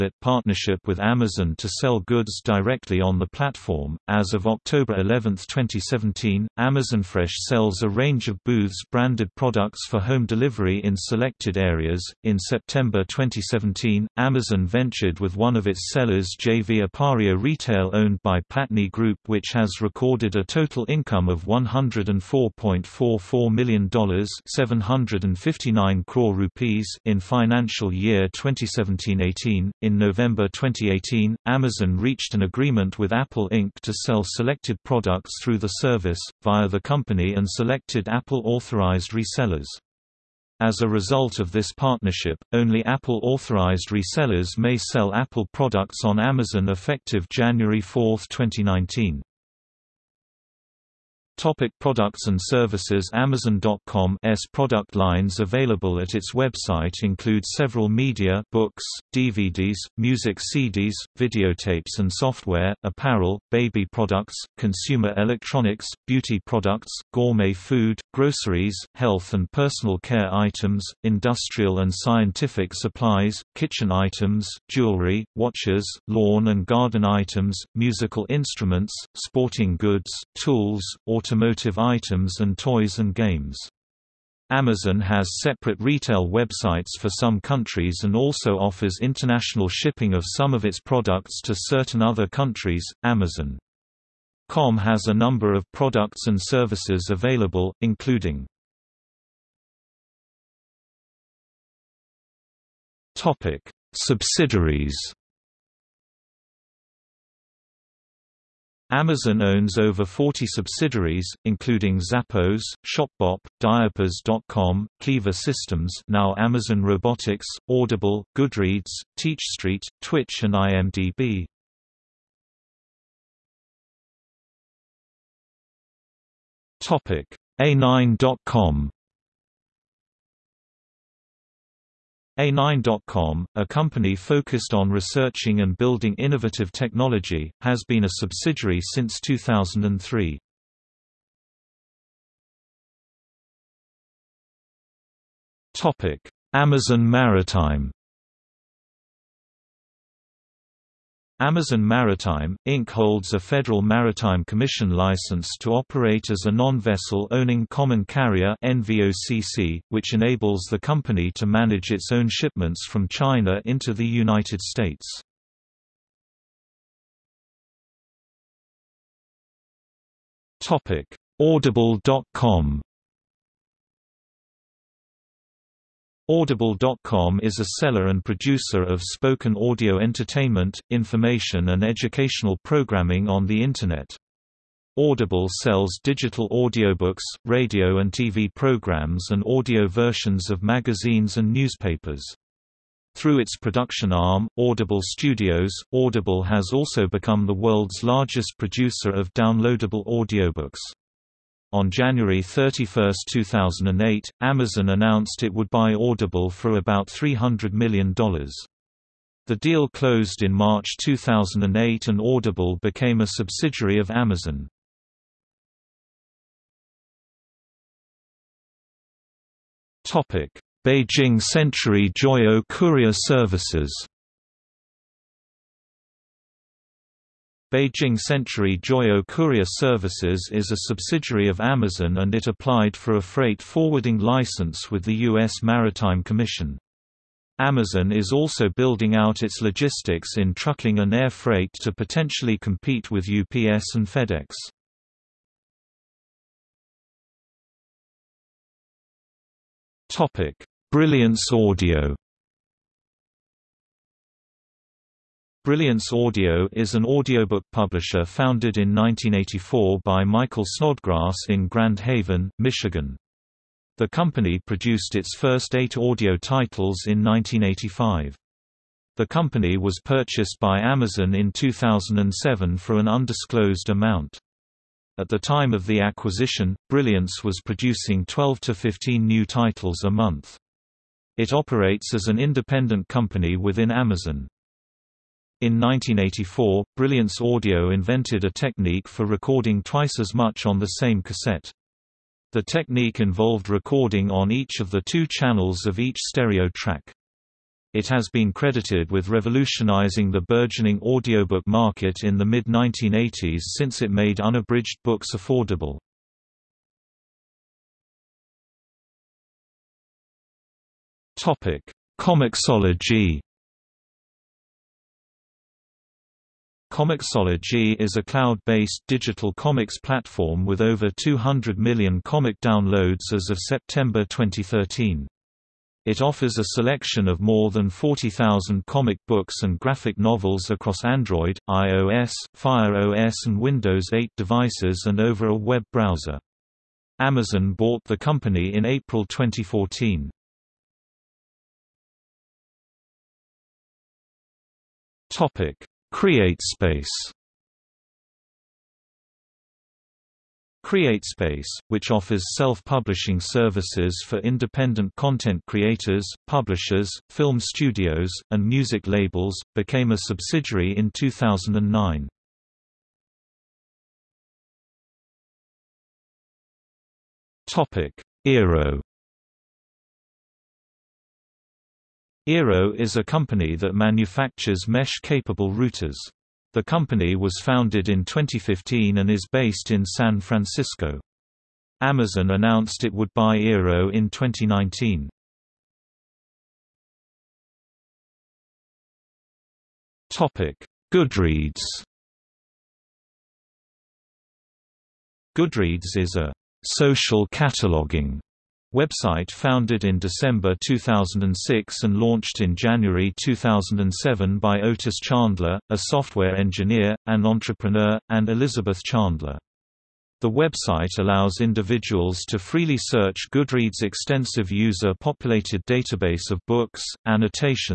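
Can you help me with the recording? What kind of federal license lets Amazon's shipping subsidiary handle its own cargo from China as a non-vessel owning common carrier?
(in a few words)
Federal Maritime Commission license.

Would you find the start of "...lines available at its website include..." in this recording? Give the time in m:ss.
0:54.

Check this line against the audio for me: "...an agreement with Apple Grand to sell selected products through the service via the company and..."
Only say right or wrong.
wrong.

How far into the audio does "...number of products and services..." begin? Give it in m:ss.
1:35.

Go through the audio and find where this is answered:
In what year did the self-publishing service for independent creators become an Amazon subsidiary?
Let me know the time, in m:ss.
6:01.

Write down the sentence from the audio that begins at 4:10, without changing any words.
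Brilliance Audio Brilliance Audio is an audiobook publisher founded in 1984 by Michael Snodgrass in Grand Haven, Michigan.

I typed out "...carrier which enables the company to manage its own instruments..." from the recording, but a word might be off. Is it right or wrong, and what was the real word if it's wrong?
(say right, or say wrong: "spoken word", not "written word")
wrong: "shipments", not "instruments".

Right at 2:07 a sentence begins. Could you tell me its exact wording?
A9.com A9.com, a company focused on researching and building innovative technology, has been a subsidiary since 2003.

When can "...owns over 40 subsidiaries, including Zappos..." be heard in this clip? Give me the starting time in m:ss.
1:49.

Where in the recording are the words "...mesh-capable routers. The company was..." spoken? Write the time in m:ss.
6:14.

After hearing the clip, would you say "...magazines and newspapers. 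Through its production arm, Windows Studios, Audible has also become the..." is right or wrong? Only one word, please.
wrong.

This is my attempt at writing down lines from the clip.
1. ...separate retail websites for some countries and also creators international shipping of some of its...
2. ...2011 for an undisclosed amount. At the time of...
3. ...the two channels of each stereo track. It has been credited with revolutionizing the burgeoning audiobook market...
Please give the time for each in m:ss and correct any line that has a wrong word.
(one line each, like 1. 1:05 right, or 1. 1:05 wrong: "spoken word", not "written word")
1. 1:25 wrong: "offers", not "creators"
2. 4:31 wrong: "2007", not "2011"
3. 4:54 right.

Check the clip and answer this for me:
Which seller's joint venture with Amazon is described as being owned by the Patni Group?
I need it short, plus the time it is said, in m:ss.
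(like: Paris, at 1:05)
Appario Retail, at 0:16.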